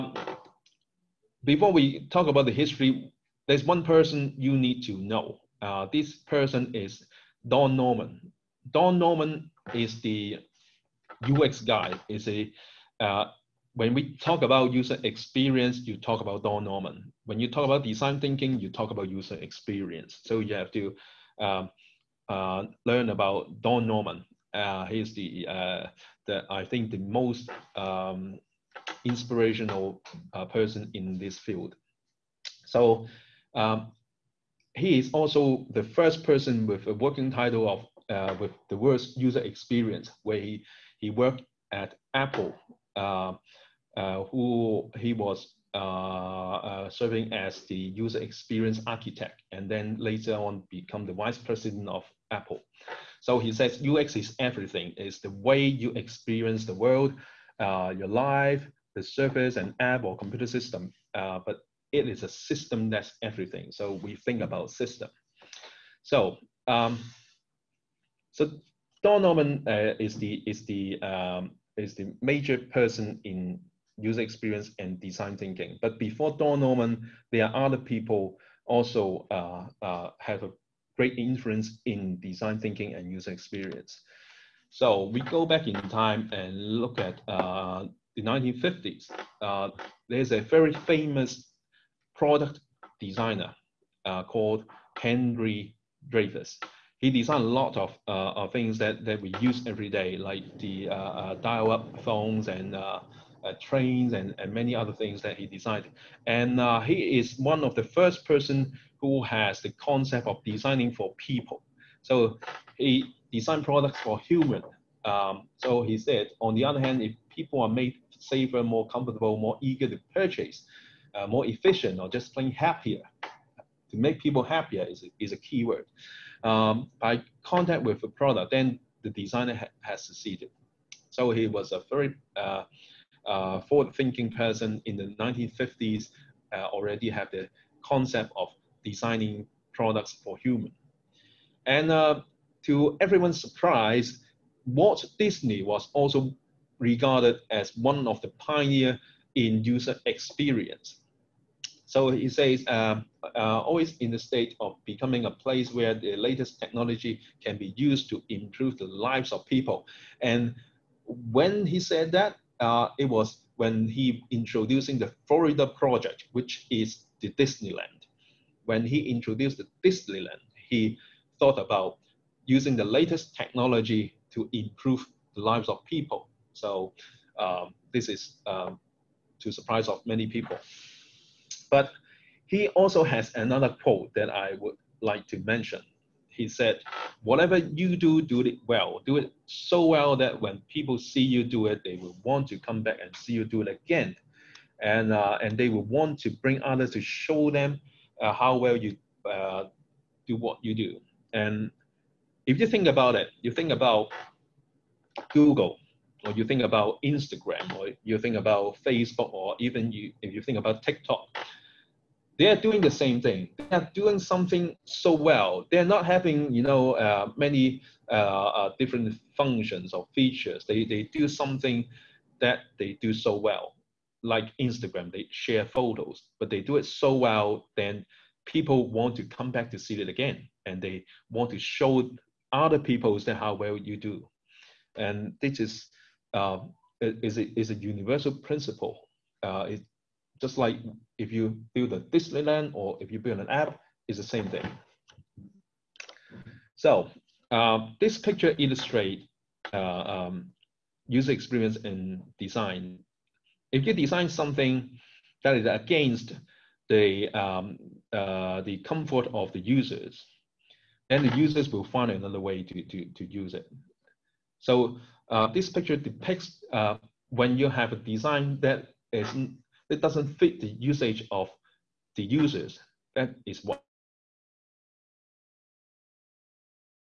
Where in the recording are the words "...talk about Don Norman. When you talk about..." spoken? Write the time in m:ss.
0:15.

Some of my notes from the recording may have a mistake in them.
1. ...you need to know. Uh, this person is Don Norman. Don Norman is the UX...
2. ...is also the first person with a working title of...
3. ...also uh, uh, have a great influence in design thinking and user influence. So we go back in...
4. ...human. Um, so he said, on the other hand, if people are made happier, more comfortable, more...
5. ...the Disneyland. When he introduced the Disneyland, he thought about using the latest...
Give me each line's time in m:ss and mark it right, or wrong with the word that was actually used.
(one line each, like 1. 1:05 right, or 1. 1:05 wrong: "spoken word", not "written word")
1. 0:04 right
2. 0:34 right
3. 1:18 wrong: "experience", not "influence"
4. 1:54 wrong: "safer", not "happier"
5. 2:47 right.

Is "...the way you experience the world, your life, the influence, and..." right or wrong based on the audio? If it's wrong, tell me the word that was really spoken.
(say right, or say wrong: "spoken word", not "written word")
wrong: "service", not "influence".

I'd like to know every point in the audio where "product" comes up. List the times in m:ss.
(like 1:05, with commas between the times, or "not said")
1:32, 1:53, 2:08, 2:19.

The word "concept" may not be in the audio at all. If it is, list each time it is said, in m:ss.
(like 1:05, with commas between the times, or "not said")
1:49, 2:17.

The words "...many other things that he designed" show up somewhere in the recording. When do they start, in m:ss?
1:44.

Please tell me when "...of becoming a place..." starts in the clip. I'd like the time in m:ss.
2:34.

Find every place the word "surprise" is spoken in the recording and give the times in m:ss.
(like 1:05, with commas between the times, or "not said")
2:23, 2:59.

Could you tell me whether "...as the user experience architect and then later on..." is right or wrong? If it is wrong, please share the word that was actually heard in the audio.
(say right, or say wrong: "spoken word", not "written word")
right.